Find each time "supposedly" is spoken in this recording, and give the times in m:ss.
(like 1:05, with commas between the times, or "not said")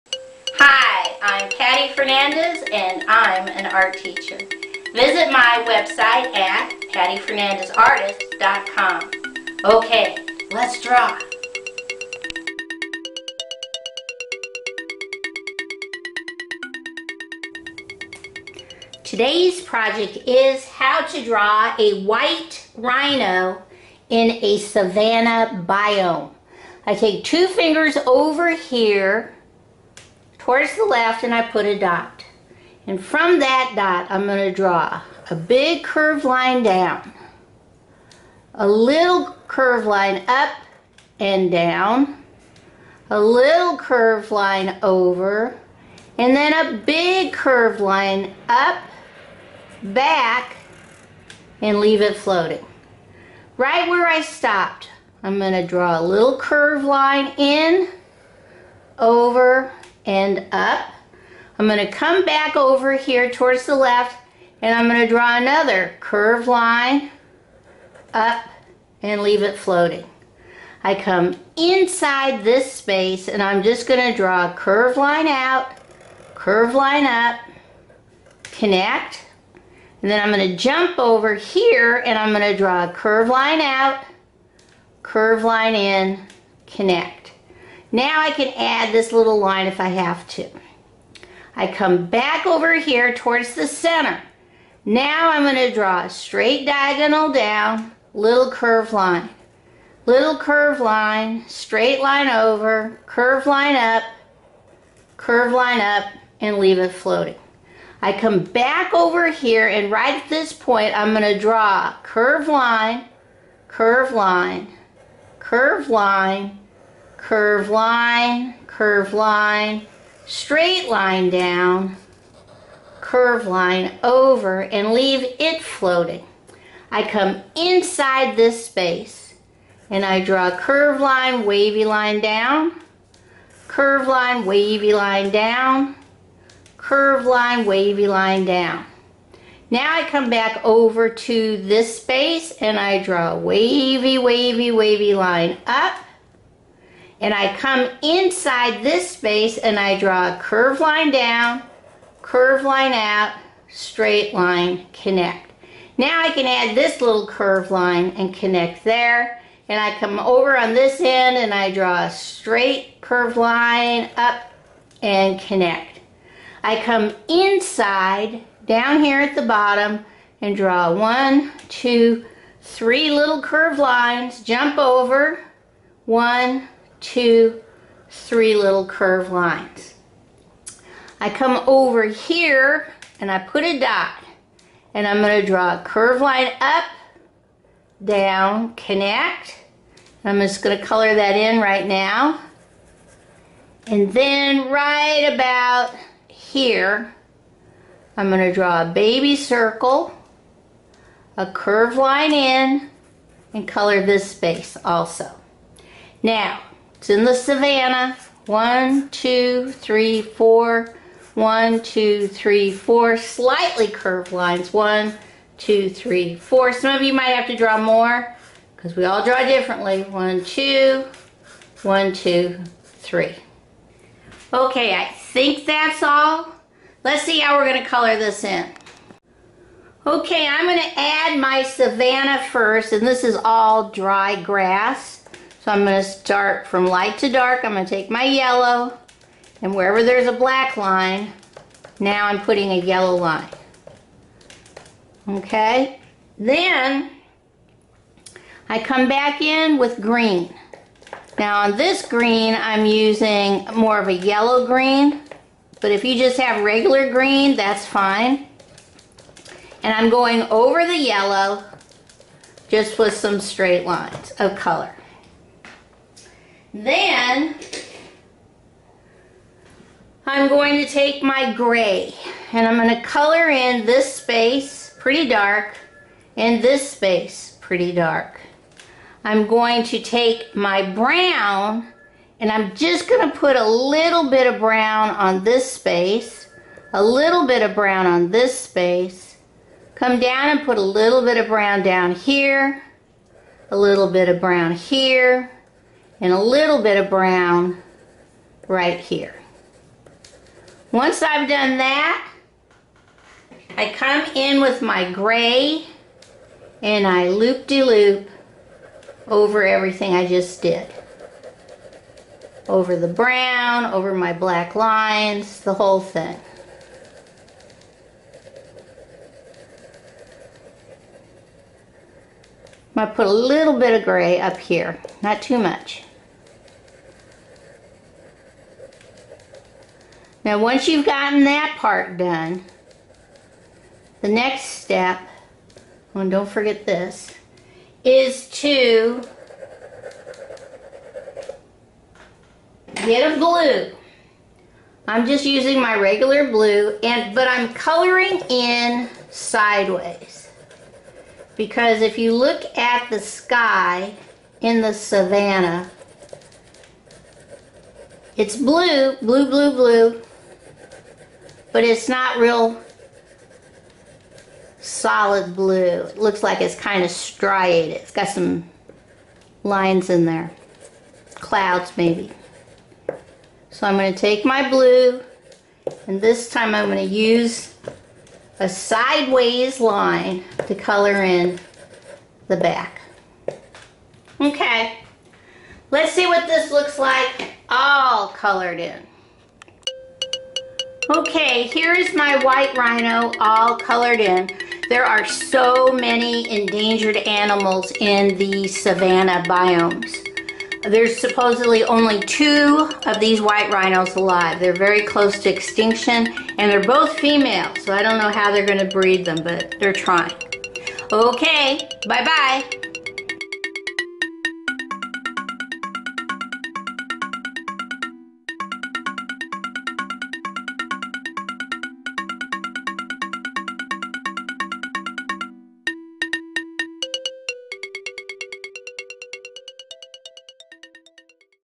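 6:41.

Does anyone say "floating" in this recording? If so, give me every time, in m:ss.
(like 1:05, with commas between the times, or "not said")
0:52, 1:09, 1:46, 2:05.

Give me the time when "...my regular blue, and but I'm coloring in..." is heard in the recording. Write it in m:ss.
5:45.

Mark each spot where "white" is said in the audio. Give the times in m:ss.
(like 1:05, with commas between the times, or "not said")
0:22, 6:32, 6:43.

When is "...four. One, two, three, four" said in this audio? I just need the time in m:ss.
3:30.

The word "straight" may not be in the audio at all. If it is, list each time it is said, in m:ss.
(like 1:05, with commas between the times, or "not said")
1:36, 1:41, 2:00, 2:33, 2:42, 4:23.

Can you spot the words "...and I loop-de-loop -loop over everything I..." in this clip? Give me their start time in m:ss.
5:06.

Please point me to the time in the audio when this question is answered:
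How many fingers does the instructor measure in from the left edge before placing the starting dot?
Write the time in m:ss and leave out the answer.
0:27.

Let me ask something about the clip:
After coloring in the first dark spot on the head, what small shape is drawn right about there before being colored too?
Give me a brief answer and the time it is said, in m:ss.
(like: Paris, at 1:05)
baby circle, at 3:18.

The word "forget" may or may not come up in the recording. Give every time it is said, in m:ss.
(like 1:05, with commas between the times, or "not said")
5:36.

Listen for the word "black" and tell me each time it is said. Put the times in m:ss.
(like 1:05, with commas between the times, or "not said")
4:00, 5:14.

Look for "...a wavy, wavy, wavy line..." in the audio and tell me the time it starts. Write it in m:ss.
2:23.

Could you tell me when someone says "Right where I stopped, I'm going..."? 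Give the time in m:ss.
0:53.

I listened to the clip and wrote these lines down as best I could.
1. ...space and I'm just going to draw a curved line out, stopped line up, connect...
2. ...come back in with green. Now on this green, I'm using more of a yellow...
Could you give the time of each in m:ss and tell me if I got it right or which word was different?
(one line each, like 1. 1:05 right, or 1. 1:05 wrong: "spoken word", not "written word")
1. 1:12 wrong: "curved", not "stopped"
2. 4:08 right.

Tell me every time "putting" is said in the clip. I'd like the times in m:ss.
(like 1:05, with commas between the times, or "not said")
4:02.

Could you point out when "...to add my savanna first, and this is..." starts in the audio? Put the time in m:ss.
3:50.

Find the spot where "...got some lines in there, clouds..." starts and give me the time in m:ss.
6:08.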